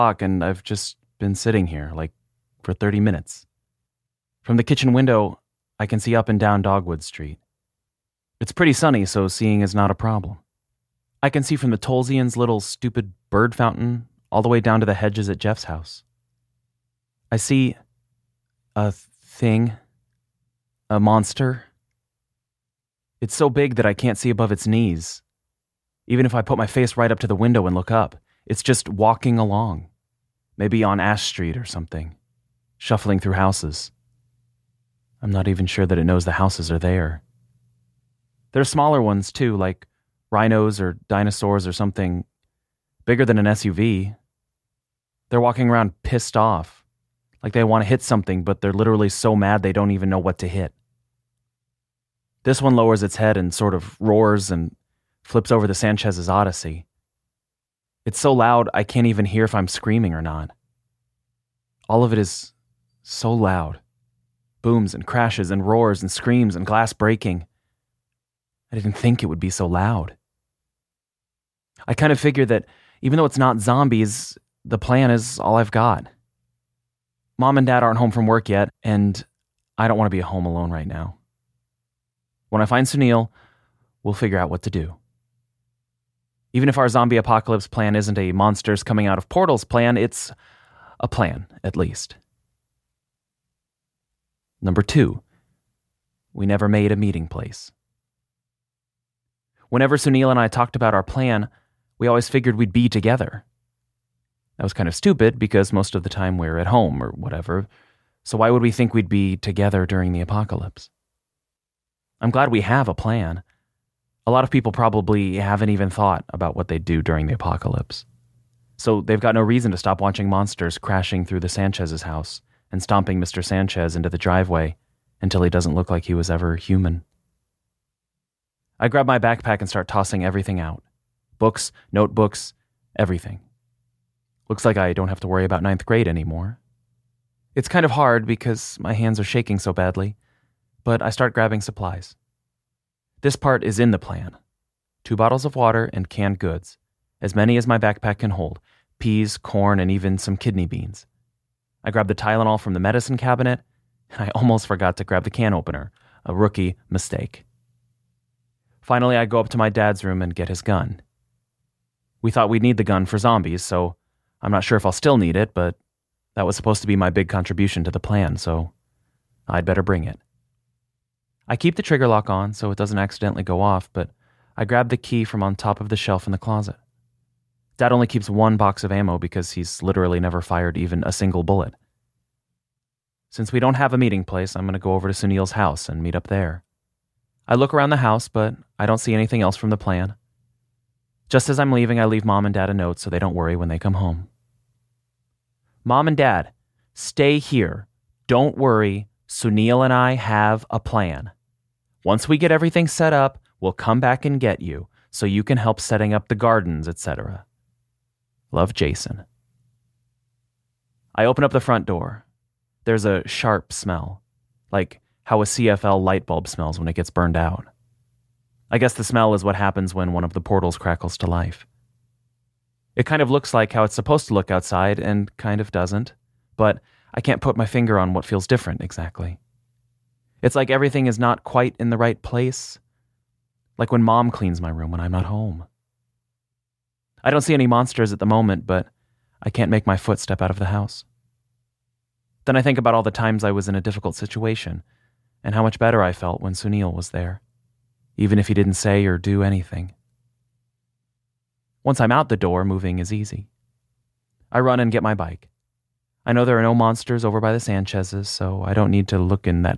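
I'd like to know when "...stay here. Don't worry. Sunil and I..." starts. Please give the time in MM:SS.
03:16.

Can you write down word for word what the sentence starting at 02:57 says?
Dad only keeps one box of ammo because he's literally never fired even a single bullet.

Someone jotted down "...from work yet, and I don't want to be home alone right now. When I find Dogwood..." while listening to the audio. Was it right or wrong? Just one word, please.
wrong.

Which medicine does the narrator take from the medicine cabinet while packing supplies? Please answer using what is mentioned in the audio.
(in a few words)
Tylenol.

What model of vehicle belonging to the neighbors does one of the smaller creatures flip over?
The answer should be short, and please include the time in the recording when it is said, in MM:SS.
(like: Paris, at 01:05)
Odyssey, at 00:56.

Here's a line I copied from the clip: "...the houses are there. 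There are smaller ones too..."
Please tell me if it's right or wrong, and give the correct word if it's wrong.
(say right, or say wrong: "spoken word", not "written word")
right.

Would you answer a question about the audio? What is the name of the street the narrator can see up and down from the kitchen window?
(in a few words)
Dogwood Street.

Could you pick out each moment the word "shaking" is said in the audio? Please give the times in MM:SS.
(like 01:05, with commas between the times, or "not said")
02:19.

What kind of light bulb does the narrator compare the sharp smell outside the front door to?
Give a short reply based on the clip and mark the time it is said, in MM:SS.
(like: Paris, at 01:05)
CFL, at 03:35.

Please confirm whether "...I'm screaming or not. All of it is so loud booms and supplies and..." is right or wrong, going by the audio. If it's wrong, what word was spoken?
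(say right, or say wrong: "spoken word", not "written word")
wrong: "crashes", not "supplies".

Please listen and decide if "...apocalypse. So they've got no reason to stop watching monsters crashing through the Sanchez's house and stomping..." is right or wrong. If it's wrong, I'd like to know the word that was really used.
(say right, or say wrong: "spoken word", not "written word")
right.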